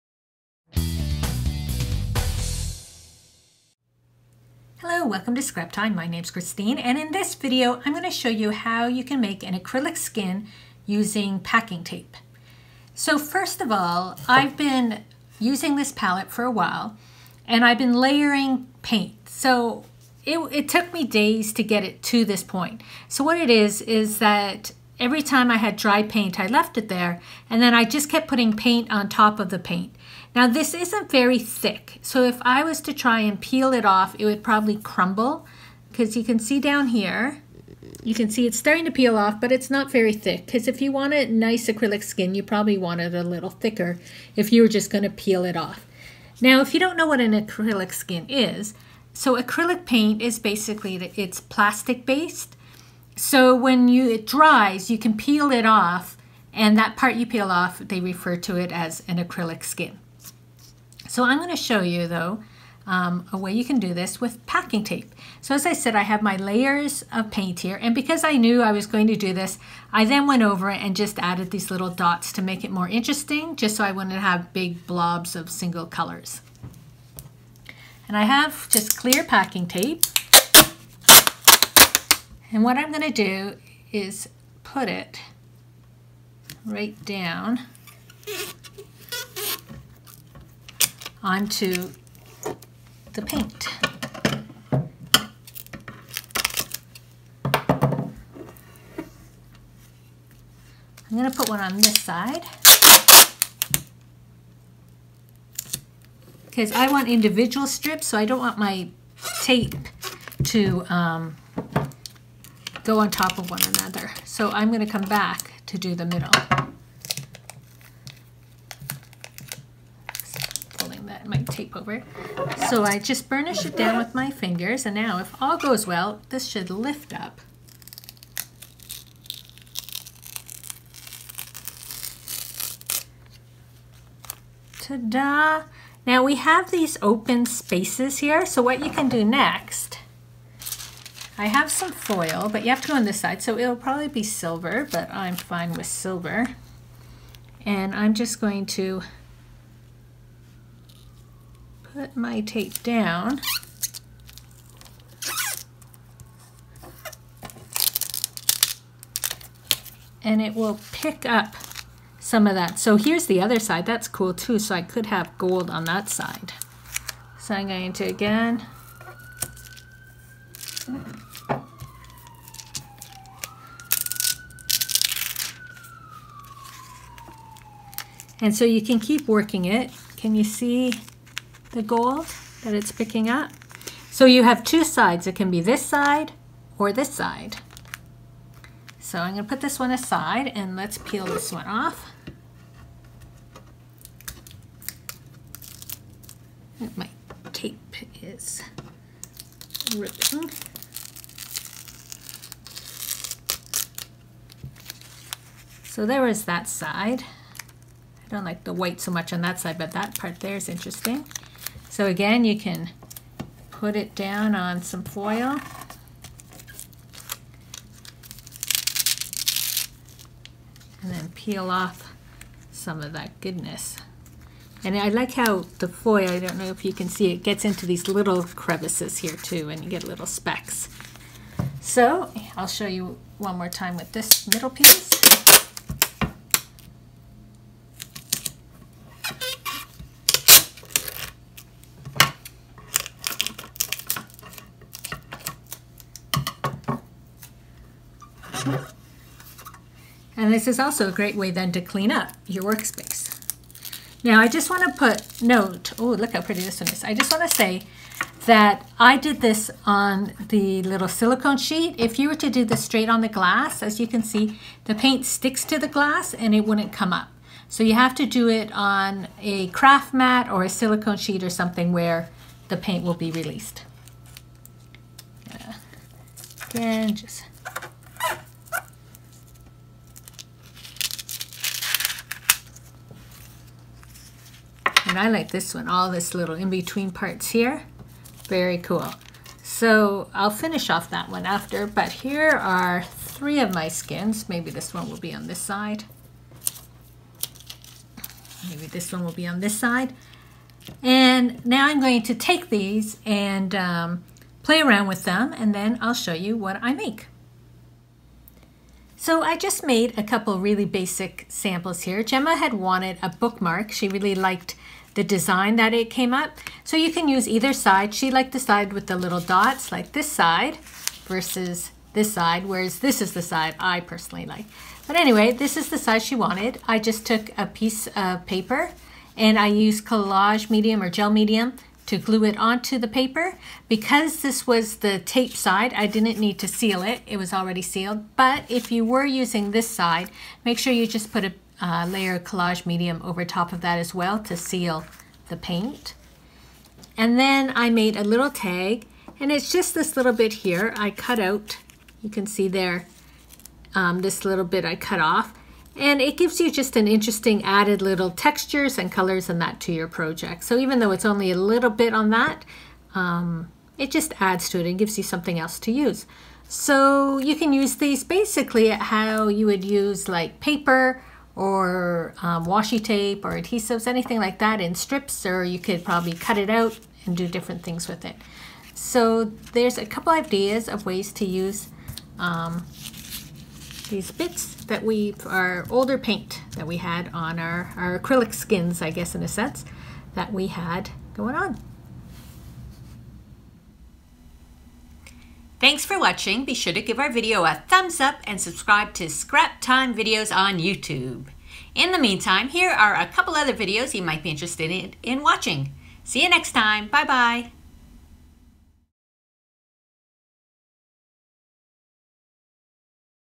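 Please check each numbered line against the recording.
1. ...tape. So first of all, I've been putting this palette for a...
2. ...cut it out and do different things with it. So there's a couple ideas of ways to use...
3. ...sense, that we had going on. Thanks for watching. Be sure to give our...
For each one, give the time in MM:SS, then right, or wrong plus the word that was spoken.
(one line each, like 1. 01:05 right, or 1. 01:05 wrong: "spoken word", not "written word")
1. 00:11 wrong: "using", not "putting"
2. 06:16 right
3. 06:29 right.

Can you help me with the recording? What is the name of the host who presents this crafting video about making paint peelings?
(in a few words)
Christine.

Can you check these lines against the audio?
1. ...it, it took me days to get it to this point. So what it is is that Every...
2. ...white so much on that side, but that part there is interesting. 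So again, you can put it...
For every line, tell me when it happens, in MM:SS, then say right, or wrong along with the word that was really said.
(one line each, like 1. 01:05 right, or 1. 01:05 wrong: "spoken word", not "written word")
1. 00:20 right
2. 03:28 right.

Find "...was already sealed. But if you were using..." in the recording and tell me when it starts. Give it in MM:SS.
05:37.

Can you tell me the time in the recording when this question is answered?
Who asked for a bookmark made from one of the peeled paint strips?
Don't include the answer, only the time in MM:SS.
05:12.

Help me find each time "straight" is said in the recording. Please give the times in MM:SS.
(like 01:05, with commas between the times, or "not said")
04:22.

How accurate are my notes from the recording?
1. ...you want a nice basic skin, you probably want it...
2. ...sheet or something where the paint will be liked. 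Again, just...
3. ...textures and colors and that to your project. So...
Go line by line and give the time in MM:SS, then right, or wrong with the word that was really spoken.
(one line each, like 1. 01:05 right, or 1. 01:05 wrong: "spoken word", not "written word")
1. 00:40 wrong: "acrylic", not "basic"
2. 04:31 wrong: "released", not "liked"
3. 05:58 right.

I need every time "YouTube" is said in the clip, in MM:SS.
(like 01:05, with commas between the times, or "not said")
06:40.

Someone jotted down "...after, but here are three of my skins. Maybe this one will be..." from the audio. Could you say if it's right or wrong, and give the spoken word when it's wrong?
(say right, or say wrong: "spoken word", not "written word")
right.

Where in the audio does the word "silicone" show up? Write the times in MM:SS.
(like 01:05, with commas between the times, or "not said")
04:21, 04:30.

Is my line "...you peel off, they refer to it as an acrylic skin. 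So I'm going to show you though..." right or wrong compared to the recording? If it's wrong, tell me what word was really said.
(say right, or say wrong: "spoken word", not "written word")
right.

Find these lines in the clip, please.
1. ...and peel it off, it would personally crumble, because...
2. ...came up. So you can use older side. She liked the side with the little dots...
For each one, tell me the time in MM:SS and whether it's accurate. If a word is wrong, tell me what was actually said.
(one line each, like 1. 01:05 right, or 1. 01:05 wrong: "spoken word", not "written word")
1. 00:33 wrong: "probably", not "personally"
2. 05:16 wrong: "either", not "older".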